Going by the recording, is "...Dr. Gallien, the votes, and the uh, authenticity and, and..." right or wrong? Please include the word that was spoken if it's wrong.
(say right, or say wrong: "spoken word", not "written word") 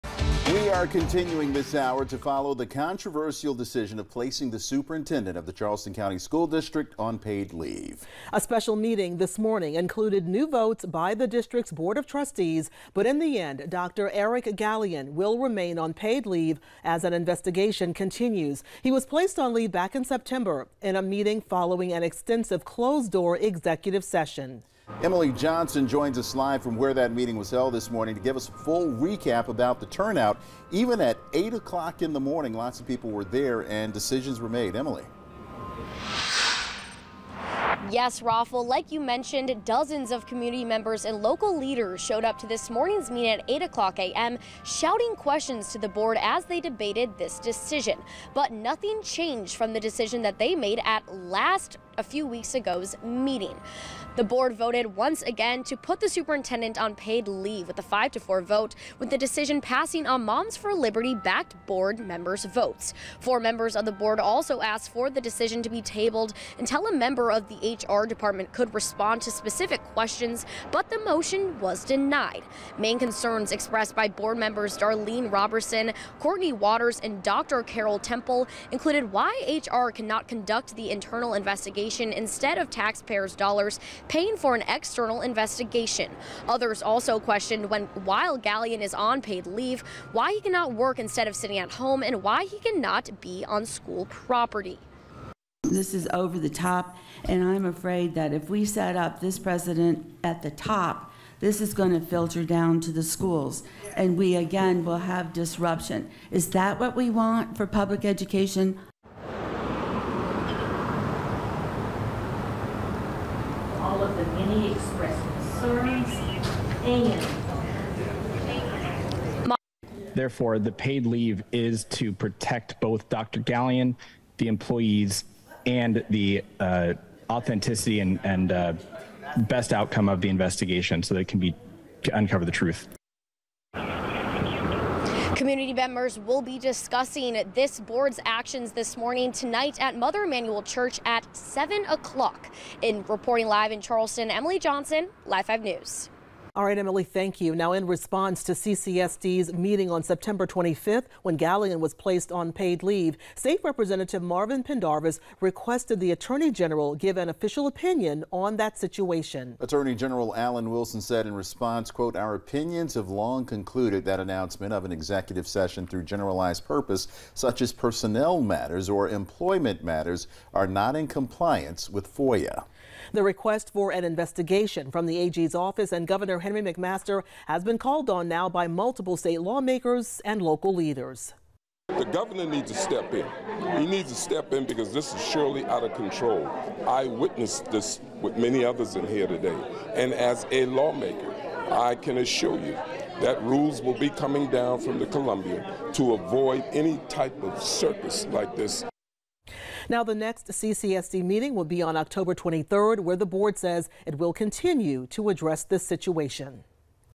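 wrong: "employees", not "votes".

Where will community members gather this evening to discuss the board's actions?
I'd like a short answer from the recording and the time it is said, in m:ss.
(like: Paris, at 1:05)
Mother Emanuel Church, at 2:19.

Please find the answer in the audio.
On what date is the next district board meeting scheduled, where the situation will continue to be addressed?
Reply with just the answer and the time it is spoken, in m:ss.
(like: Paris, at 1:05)
October 23rd, at 3:21.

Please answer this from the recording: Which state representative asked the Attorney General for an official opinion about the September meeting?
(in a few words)
Marvin Pendarvis.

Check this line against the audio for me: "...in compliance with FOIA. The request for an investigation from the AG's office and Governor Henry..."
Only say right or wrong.
right.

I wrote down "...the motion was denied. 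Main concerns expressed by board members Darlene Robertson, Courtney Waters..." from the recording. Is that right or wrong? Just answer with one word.
right.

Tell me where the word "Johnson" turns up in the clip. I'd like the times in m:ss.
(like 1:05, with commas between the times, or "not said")
0:25, 2:24.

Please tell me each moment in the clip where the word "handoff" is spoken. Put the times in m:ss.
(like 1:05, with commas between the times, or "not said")
not said.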